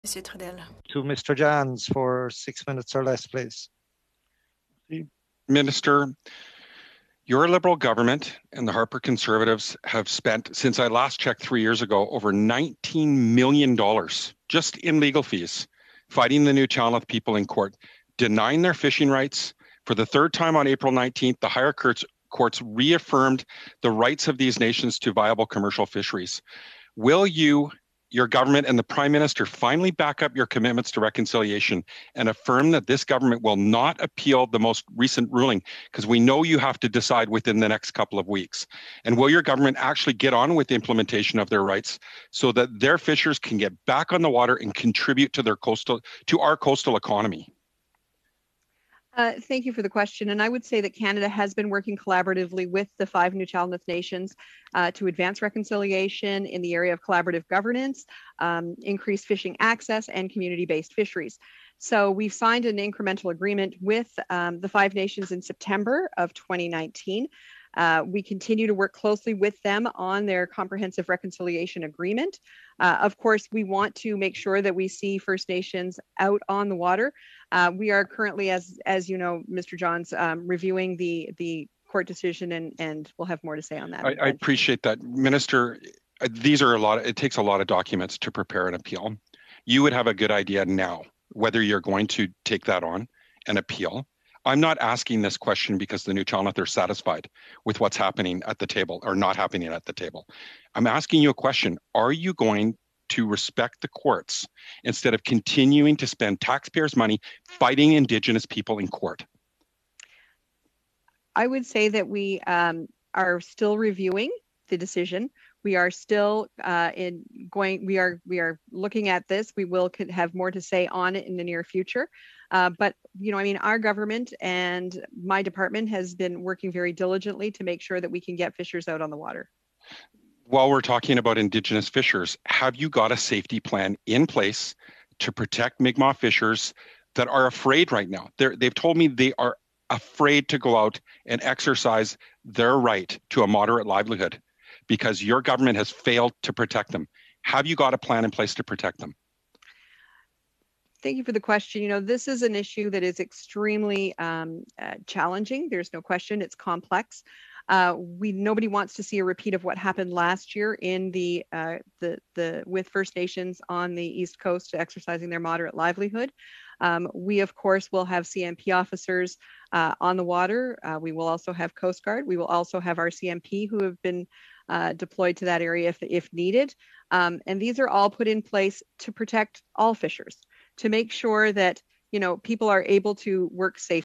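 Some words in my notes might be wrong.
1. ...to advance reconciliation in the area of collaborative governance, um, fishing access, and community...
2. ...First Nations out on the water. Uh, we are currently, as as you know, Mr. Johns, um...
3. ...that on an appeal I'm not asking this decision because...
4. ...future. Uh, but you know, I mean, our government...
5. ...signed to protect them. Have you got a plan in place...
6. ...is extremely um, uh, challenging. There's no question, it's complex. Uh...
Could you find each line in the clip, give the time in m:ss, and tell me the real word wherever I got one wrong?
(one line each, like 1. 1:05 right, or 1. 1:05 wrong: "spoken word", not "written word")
1. 0:54 right
2. 1:15 right
3. 1:32 wrong: "question", not "decision"
4. 2:01 right
5. 2:25 wrong: "failed", not "signed"
6. 2:33 right.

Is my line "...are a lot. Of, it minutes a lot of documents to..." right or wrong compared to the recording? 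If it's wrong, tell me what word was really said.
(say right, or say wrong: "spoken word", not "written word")
wrong: "takes", not "minutes".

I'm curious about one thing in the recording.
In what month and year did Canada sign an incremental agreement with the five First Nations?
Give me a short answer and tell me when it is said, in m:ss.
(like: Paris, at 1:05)
September 2019, at 1:05.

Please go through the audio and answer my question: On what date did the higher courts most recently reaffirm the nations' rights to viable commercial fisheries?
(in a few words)
April 19th.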